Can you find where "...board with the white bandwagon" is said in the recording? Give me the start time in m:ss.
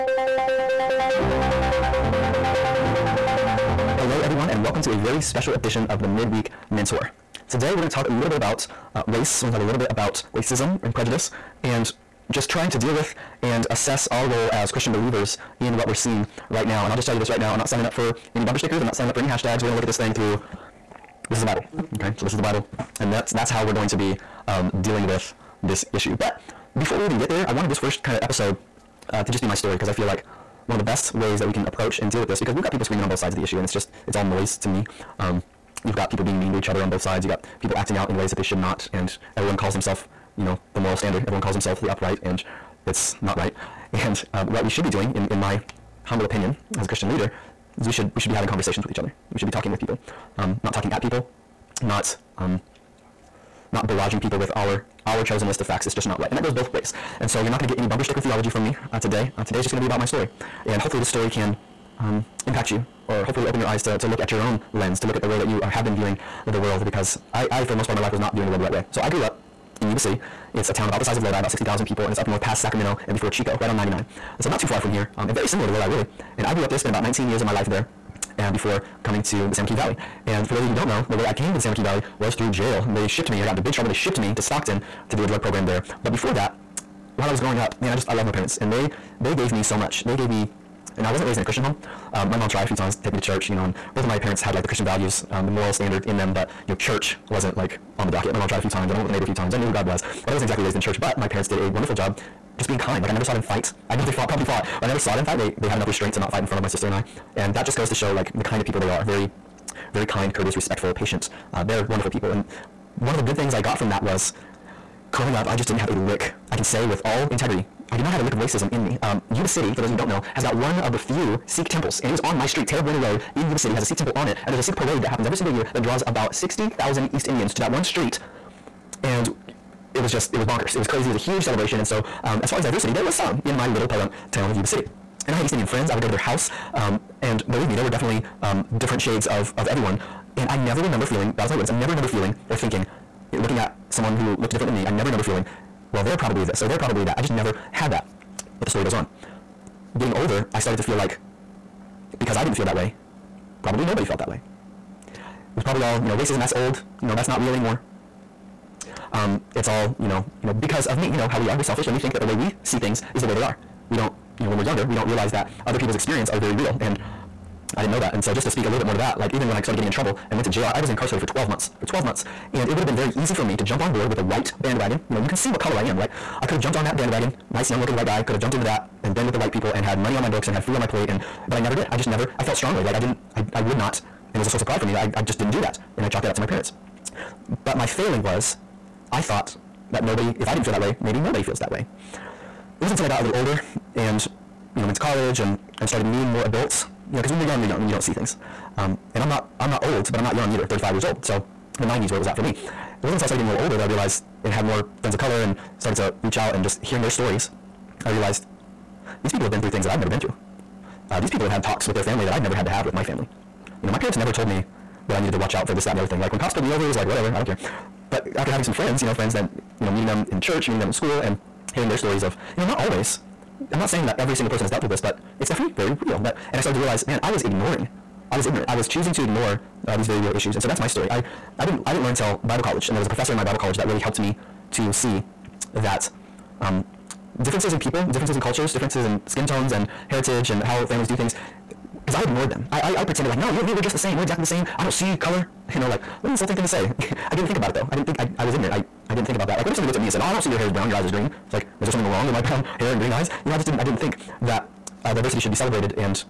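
2:53.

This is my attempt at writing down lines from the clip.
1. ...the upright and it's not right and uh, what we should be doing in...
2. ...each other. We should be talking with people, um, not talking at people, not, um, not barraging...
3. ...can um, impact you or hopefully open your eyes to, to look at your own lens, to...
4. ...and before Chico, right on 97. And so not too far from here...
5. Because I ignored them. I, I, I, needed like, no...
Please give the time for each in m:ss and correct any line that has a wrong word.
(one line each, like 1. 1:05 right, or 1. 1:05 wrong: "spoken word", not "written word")
1. 0:41 right
2. 0:48 right
3. 1:01 right
4. 1:13 wrong: "99", not "97"
5. 4:02 wrong: "pretended", not "needed".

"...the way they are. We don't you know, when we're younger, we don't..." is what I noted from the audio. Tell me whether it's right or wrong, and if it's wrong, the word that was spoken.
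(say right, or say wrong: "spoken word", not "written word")
right.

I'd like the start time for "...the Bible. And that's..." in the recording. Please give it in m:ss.
0:22.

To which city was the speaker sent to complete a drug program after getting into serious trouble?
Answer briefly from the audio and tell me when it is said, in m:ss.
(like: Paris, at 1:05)
Stockton, at 1:24.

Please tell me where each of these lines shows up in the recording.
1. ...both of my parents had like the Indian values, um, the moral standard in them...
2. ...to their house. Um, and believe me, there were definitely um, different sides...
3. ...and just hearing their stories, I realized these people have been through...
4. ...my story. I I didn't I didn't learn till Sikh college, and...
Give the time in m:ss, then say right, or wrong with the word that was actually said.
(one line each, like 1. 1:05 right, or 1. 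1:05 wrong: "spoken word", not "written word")
1. 1:33 wrong: "Christian", not "Indian"
2. 2:16 wrong: "shades", not "sides"
3. 3:26 right
4. 3:50 wrong: "Bible", not "Sikh".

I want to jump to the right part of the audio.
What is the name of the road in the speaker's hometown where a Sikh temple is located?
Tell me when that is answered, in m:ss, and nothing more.
2:02.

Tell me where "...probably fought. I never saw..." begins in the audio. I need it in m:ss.
1:44.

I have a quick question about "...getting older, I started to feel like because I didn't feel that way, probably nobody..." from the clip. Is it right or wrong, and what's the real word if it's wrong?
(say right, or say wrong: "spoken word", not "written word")
right.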